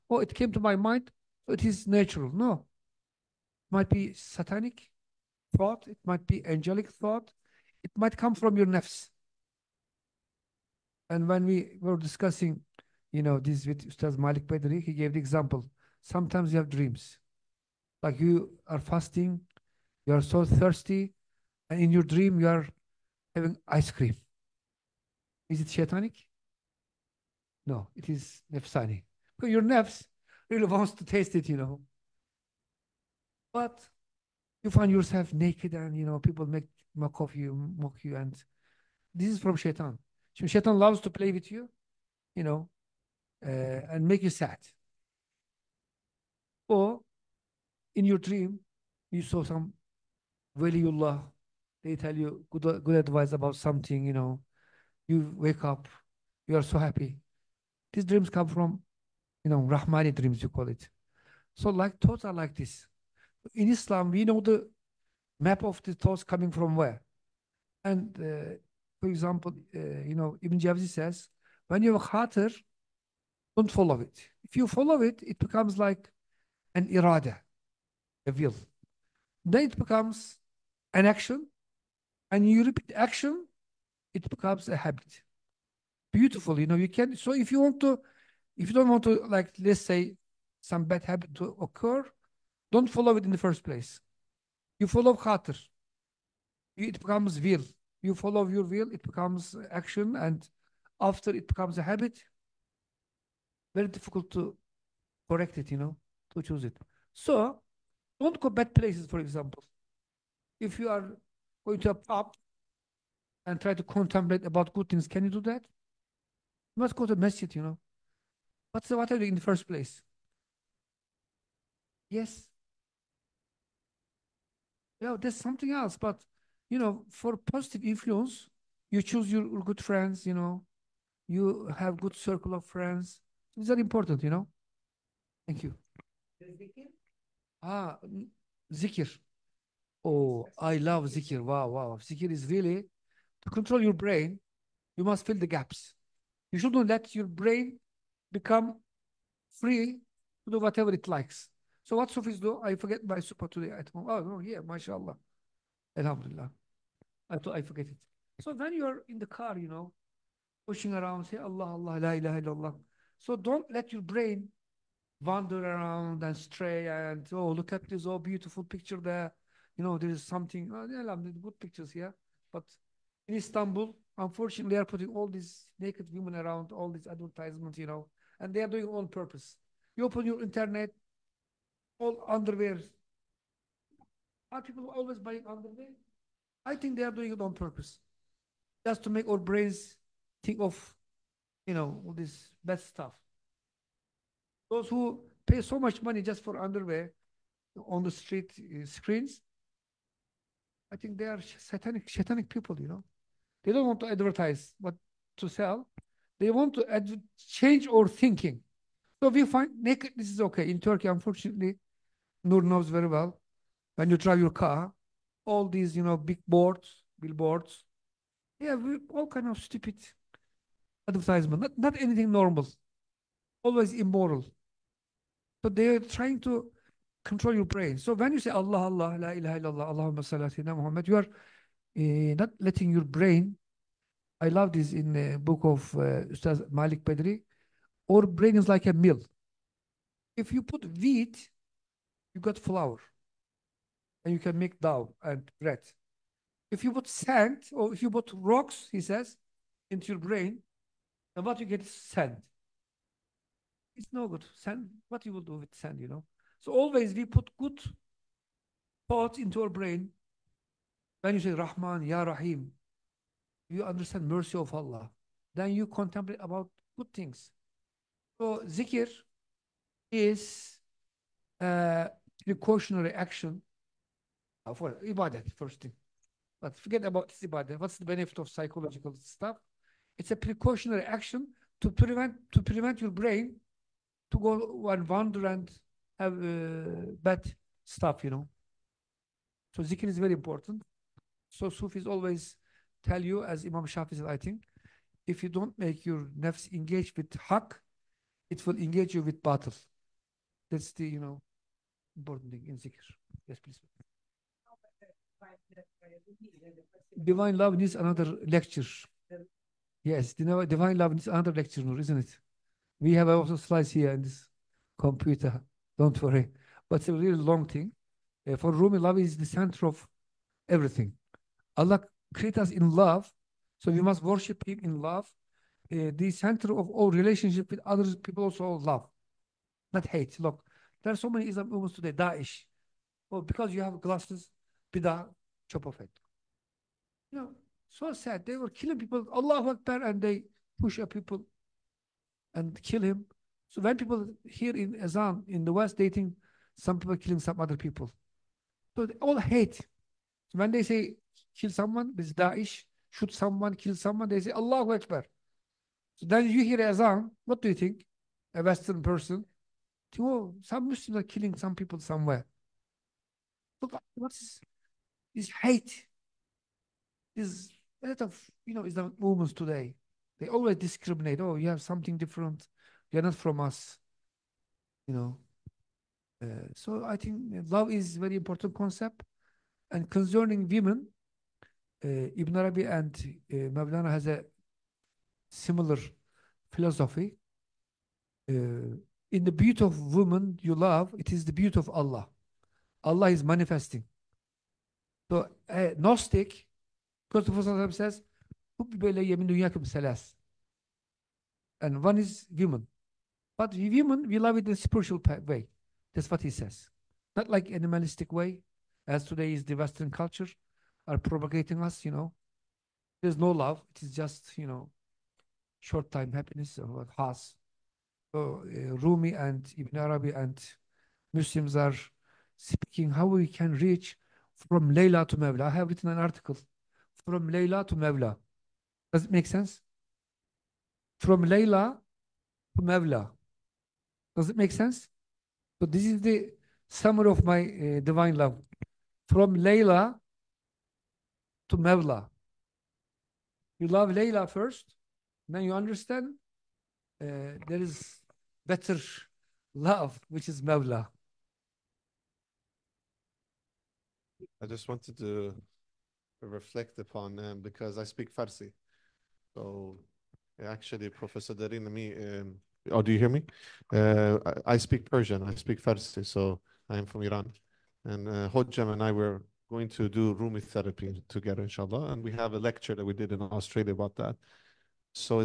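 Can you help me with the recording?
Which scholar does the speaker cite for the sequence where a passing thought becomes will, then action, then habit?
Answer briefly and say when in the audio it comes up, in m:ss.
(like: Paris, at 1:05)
Ibn Jawzi, at 1:10.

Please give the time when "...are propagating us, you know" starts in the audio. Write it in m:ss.
6:51.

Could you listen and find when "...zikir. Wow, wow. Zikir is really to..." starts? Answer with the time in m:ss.
2:21.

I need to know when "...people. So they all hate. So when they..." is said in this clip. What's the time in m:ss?
5:47.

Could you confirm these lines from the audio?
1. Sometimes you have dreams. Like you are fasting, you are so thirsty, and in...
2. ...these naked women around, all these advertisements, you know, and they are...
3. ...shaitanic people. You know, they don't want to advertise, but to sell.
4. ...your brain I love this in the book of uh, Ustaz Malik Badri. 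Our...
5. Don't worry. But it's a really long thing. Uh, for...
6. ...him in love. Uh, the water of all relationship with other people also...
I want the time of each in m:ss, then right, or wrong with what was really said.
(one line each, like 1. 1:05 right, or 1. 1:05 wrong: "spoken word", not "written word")
1. 0:16 right
2. 2:55 right
3. 3:22 wrong: "satanic", not "shaitanic"
4. 3:52 right
5. 5:15 right
6. 5:24 wrong: "center", not "water".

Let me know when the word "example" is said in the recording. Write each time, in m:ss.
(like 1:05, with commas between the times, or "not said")
0:15, 1:09, 1:49.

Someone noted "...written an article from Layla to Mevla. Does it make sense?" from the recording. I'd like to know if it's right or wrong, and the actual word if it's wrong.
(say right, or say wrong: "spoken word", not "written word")
right.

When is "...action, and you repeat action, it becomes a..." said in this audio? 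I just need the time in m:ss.
1:21.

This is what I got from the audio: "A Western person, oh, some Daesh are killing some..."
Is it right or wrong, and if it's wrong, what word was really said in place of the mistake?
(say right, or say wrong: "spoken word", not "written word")
wrong: "Muslims", not "Daesh".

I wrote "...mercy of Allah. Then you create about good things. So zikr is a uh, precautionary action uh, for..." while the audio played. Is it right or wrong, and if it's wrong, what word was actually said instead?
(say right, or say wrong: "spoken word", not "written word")
wrong: "contemplate", not "create".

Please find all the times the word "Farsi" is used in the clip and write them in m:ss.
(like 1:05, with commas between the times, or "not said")
7:38, 7:45.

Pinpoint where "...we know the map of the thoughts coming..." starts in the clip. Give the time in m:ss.
1:04.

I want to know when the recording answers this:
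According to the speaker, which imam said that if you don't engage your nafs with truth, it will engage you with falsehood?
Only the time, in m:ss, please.
4:53.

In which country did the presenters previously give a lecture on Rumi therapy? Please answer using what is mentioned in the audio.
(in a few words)
Australia.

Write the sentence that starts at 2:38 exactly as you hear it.
So when you're in the car, you know, pushing around, say Allah, Allah, la ilaha illallah.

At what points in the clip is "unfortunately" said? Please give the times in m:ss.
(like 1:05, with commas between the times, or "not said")
2:54, 3:31.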